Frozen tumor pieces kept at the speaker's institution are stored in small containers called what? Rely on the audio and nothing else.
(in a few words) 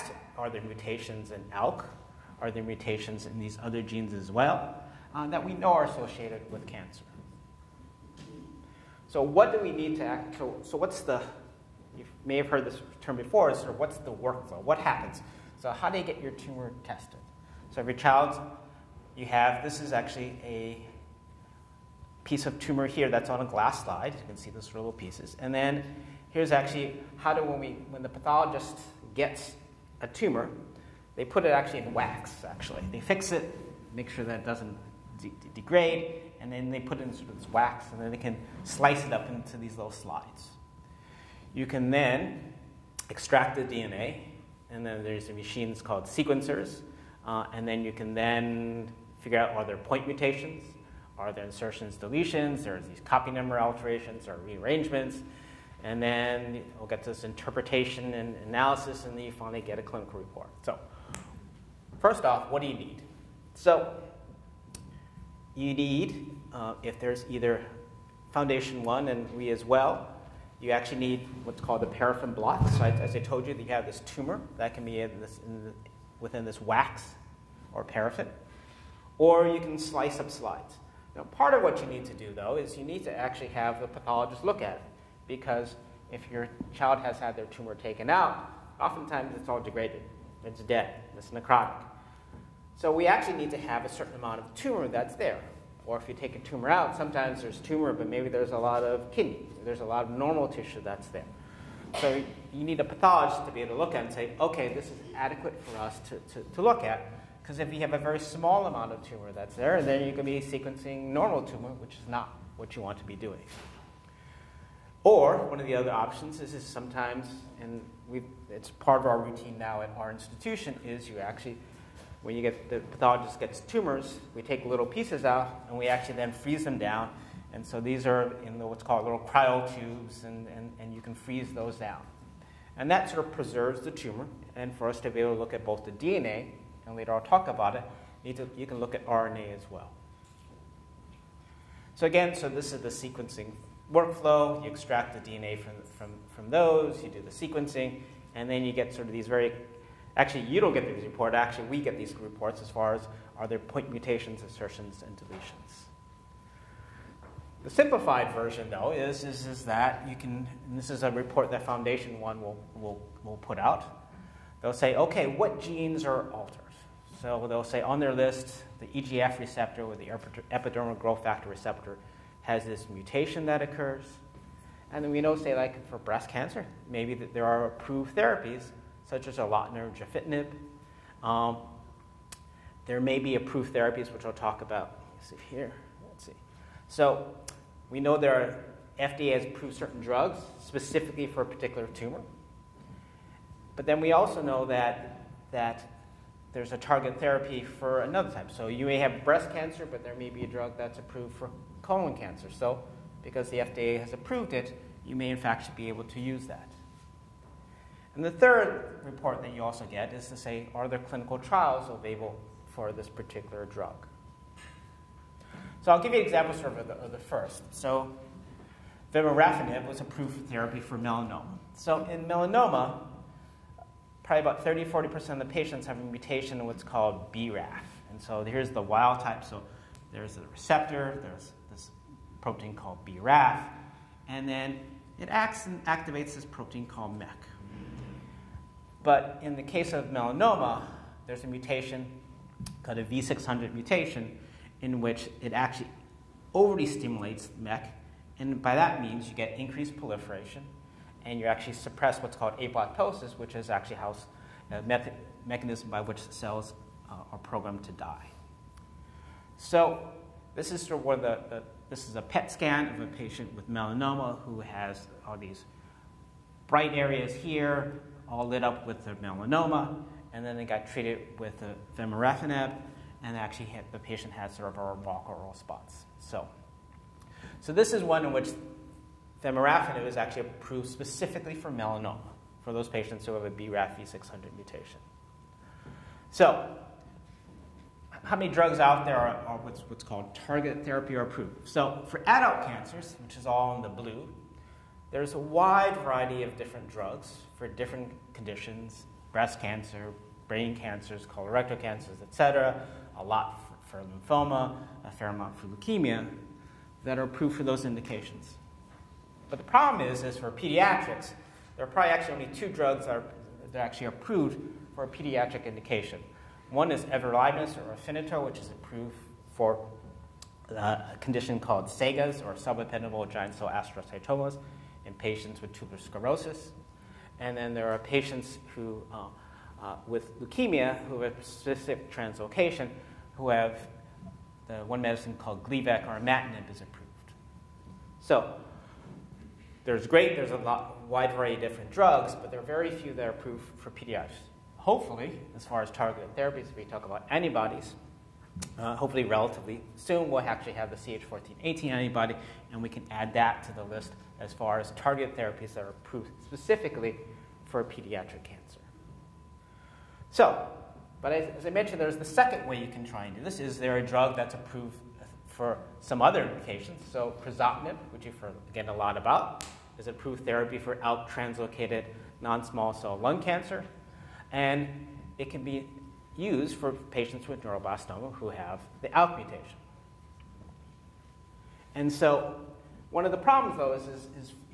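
cryotubes.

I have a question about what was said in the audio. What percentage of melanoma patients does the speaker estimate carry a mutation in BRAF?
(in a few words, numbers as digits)
30 to 40%.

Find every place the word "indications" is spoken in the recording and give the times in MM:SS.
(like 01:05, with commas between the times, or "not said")
05:07, 05:15, 06:06.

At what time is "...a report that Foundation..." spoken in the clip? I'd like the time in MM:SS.
02:41.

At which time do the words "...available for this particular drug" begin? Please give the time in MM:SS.
03:31.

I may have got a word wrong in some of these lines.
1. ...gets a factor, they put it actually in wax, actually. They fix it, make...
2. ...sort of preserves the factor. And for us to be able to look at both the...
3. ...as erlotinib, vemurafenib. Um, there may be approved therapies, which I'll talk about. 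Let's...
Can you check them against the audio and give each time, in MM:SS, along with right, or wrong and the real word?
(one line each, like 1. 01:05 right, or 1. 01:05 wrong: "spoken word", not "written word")
1. 00:29 wrong: "tumor", not "factor"
2. 02:13 wrong: "tumor", not "factor"
3. 02:59 wrong: "gefitinib", not "vemurafenib".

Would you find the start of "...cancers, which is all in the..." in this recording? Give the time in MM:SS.
04:52.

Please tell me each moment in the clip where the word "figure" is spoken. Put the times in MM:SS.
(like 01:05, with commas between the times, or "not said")
00:49.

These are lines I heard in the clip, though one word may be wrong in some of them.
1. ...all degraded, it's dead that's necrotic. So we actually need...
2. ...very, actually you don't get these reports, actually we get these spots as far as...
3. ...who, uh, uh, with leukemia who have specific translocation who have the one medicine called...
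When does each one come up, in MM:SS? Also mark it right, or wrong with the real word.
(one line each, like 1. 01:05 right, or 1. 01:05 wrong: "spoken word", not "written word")
1. 01:29 right
2. 02:29 wrong: "reports", not "spots"
3. 05:28 right.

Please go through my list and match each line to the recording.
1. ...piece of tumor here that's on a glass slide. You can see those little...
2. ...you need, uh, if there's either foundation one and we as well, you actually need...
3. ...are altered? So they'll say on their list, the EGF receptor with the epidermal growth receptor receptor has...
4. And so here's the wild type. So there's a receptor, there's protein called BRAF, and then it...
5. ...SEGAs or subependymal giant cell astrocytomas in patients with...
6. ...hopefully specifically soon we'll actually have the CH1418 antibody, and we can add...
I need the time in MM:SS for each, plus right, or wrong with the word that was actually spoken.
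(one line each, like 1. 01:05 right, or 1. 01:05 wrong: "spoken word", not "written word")
1. 00:22 right
2. 01:05 right
3. 02:46 wrong: "factor", not "receptor"
4. 03:48 right
5. 05:21 right
6. 05:48 wrong: "relatively", not "specifically".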